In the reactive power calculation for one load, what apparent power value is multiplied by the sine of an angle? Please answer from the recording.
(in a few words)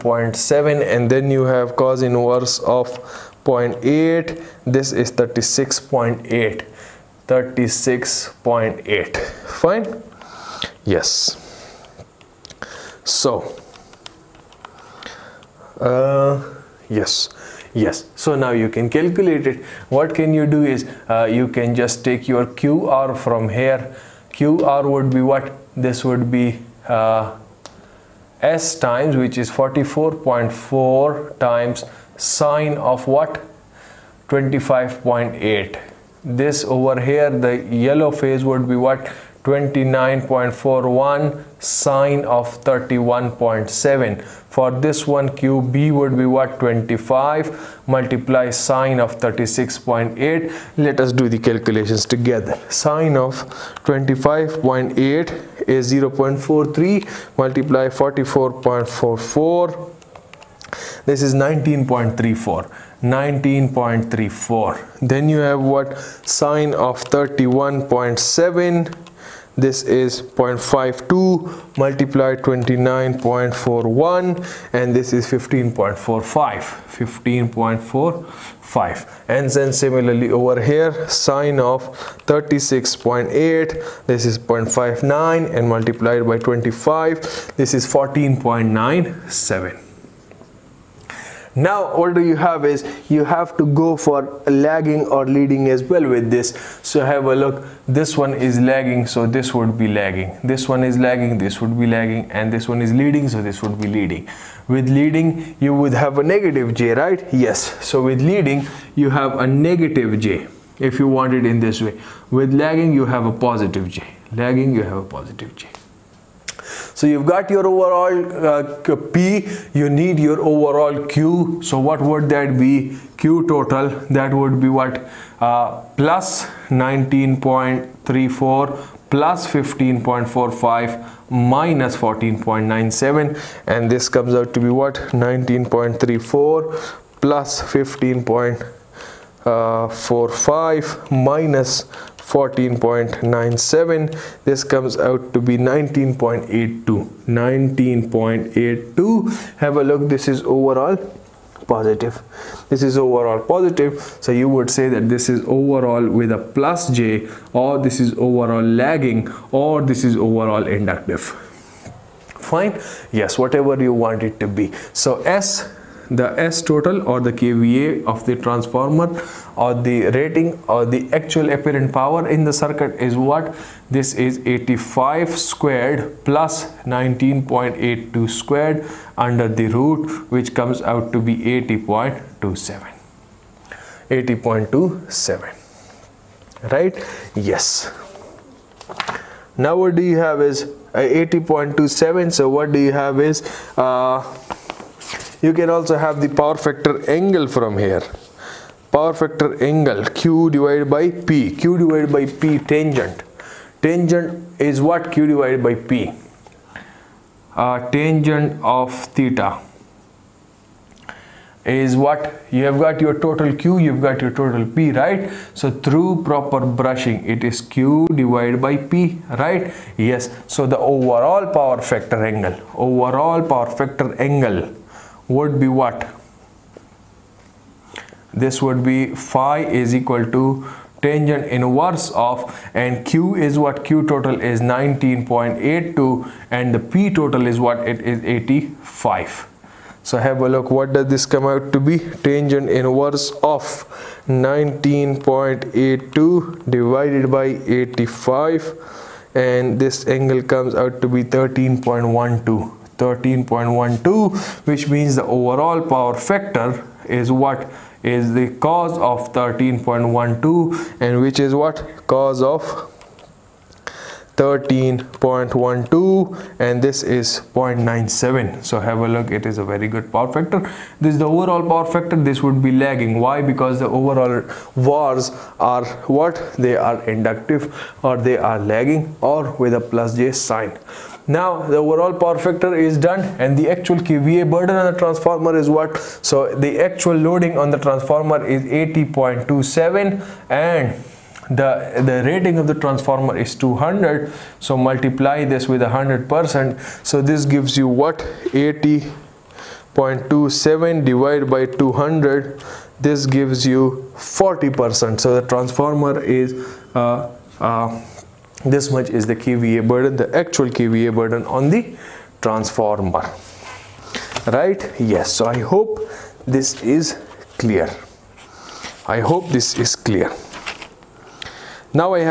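44.4.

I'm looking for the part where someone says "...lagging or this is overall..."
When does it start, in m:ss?
2:38.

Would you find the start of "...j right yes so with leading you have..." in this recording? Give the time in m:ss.
1:46.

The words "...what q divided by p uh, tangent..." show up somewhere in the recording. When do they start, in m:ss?
3:24.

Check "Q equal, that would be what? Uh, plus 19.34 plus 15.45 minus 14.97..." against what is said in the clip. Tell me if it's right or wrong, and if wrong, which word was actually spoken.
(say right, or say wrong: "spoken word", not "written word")
wrong: "total", not "equal".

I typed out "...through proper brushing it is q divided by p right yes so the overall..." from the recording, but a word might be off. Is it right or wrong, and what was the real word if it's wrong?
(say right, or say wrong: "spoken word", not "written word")
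right.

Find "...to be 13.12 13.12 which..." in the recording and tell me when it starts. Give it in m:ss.
4:10.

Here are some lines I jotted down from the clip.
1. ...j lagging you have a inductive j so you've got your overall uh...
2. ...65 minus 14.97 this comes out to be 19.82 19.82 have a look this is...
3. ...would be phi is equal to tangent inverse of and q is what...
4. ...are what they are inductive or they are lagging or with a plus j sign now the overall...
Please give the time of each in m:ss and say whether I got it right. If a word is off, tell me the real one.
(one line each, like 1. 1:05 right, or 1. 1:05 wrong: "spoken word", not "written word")
1. 1:53 wrong: "positive", not "inductive"
2. 2:19 wrong: "45", not "65"
3. 3:48 right
4. 4:35 right.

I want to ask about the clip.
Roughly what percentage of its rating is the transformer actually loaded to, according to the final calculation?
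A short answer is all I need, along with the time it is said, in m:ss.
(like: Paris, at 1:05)
40 percent, at 5:04.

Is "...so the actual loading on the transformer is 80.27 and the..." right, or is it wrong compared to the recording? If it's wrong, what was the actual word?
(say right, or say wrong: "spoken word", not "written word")
right.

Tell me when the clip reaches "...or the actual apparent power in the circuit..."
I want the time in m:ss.
2:50.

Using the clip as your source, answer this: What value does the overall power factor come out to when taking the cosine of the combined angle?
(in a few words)
0.97.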